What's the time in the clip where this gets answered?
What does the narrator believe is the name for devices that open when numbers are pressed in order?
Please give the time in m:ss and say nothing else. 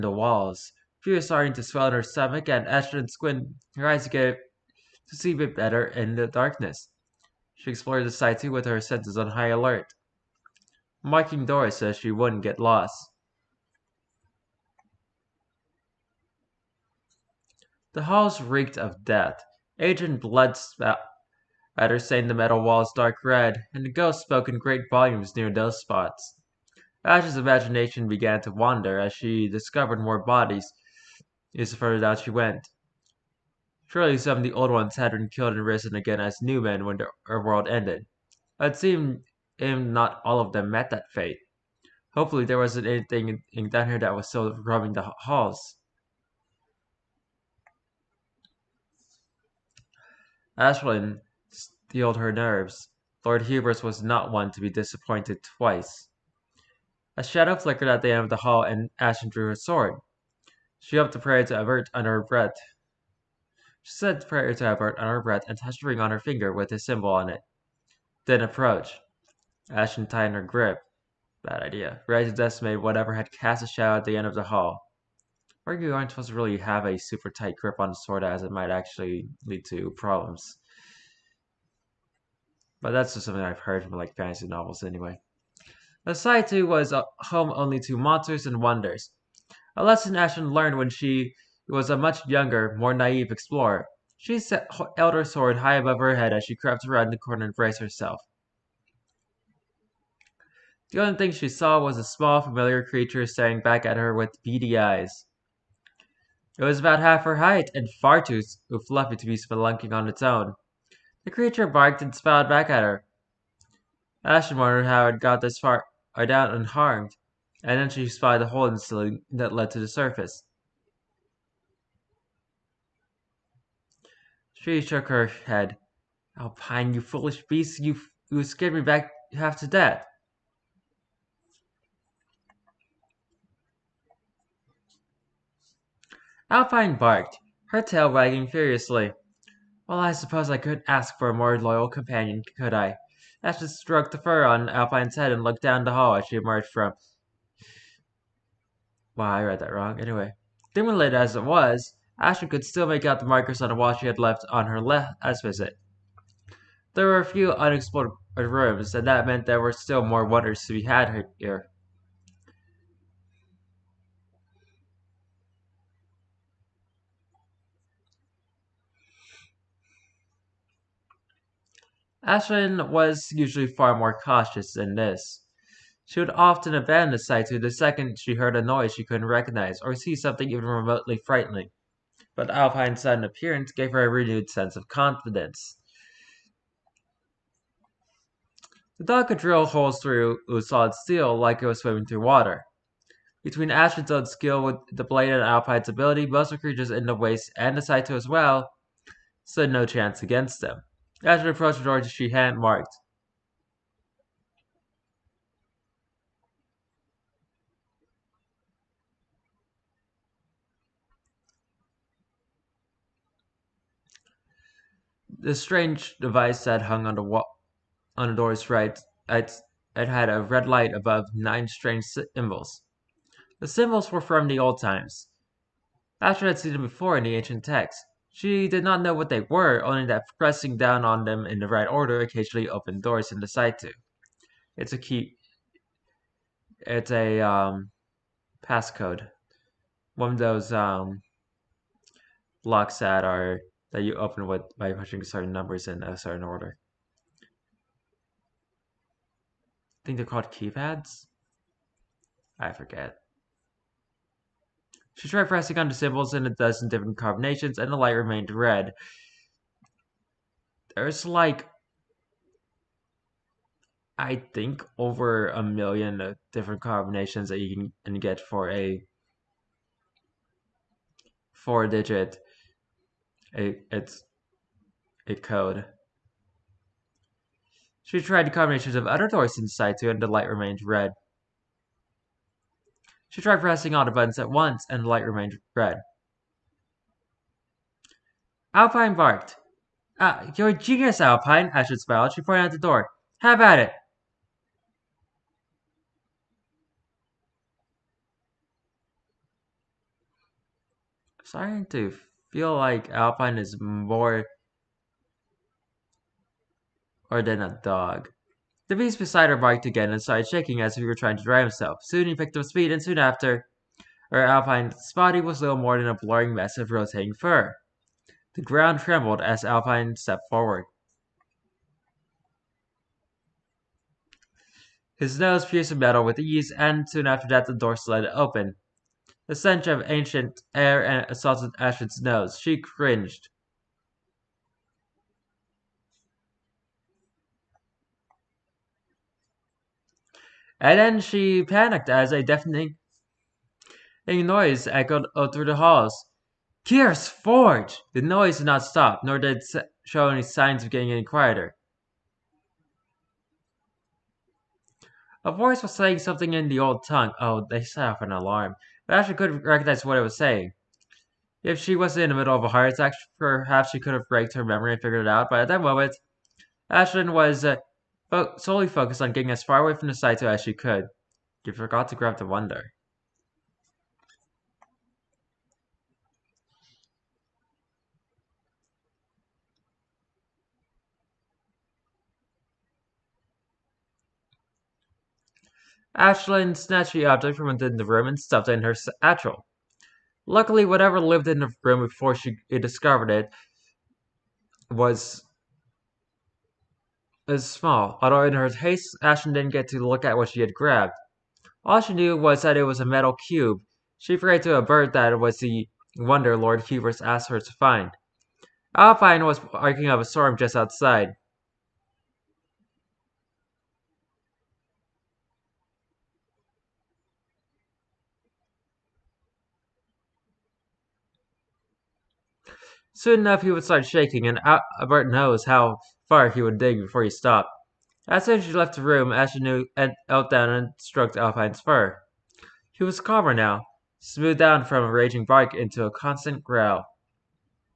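4:10.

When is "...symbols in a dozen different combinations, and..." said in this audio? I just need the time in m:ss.
4:15.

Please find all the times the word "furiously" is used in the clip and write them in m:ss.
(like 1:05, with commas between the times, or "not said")
2:18.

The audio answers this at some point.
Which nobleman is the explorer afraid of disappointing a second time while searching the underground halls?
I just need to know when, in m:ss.
0:53.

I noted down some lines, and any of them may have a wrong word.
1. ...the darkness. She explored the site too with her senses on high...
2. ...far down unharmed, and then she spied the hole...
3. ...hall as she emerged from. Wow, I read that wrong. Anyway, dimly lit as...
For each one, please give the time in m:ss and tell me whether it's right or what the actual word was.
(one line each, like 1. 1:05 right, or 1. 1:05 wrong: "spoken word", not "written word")
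1. 0:06 right
2. 1:55 right
3. 2:25 right.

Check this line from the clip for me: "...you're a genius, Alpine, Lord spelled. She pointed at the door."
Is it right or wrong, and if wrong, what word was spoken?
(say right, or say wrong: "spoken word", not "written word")
wrong: "Ashwood", not "Lord".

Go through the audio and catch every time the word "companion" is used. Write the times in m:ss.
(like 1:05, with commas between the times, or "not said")
2:21.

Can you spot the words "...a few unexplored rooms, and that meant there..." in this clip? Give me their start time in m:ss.
2:37.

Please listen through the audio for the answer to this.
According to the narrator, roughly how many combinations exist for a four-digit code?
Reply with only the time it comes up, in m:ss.
4:24.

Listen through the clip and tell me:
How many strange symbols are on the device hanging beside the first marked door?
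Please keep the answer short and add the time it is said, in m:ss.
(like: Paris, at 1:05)
9, at 3:41.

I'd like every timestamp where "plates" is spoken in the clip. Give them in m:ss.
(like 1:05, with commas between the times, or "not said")
not said.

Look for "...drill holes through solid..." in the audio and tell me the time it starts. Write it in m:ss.
3:09.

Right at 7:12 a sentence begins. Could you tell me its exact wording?
He was calmer now, smoothed down from a raging bark into a constant growl.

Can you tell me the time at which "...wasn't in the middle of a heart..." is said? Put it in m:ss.
6:01.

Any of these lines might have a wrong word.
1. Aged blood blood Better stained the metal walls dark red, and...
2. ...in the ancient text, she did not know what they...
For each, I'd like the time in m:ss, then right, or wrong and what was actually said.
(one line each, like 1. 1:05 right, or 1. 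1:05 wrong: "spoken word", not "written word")
1. 0:19 right
2. 3:47 right.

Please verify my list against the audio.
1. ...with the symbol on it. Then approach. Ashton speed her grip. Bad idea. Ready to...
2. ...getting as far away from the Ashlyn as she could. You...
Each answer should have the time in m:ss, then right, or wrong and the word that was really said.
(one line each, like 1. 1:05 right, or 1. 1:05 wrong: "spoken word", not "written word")
1. 1:06 wrong: "tightened", not "speed"
2. 6:09 wrong: "Saito", not "Ashlyn".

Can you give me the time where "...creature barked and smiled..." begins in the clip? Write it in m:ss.
1:51.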